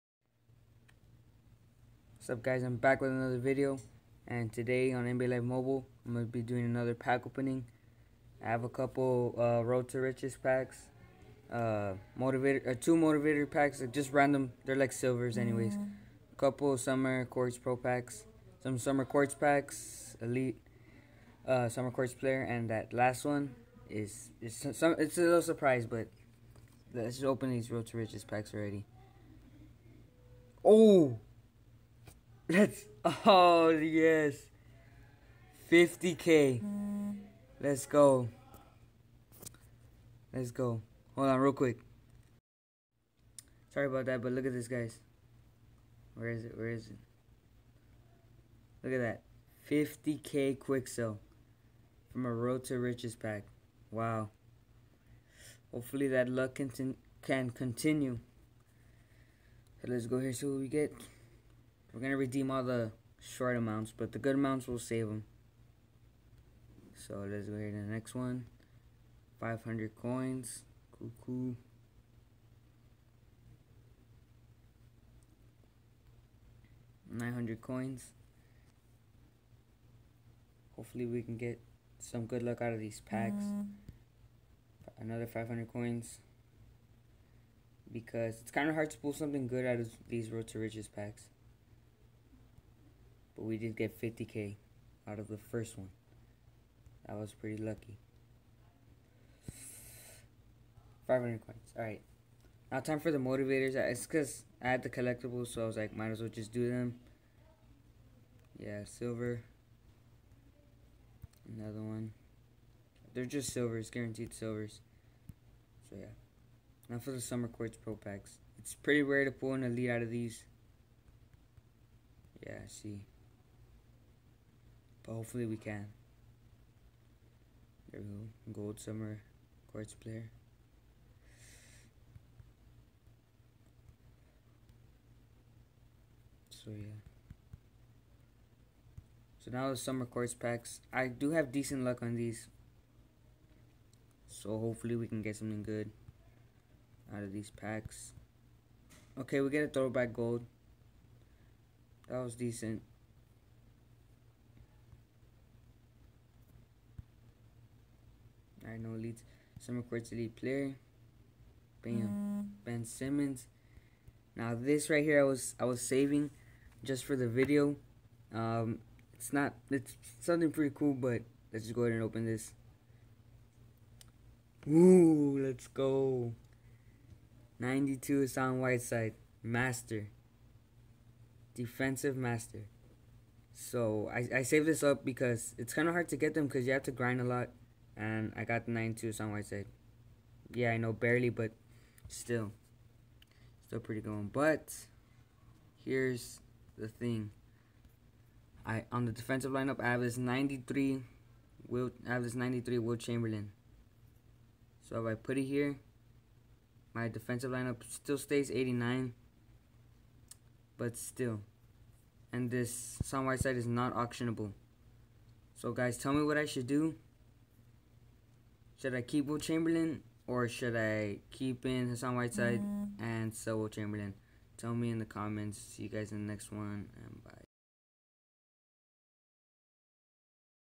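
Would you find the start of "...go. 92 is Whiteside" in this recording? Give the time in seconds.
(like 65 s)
175 s.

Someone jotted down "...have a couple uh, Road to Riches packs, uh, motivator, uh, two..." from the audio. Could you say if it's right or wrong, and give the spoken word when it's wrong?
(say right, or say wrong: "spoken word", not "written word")
right.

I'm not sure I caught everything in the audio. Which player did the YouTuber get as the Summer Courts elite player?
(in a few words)
Ben Simmons.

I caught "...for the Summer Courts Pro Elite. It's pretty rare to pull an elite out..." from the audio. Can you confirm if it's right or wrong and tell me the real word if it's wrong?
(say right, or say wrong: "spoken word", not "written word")
wrong: "Packs", not "Elite".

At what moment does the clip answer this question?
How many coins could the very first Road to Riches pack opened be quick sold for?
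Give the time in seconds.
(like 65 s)
49 s.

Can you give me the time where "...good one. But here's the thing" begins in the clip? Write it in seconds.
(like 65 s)
194 s.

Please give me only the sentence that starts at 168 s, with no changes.
Um it's not it's something pretty cool, but let's just go ahead and open this.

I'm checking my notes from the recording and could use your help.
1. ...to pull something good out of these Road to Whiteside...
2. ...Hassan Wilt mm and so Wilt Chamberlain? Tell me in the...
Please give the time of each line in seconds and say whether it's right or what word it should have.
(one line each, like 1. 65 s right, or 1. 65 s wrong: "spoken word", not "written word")
1. 88 s wrong: "Riches", not "Whiteside"
2. 221 s wrong: "Whiteside", not "Wilt".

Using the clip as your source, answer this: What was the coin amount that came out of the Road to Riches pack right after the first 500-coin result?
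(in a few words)
900 coins.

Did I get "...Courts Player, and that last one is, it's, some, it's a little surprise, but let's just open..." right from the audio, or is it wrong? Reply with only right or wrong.
right.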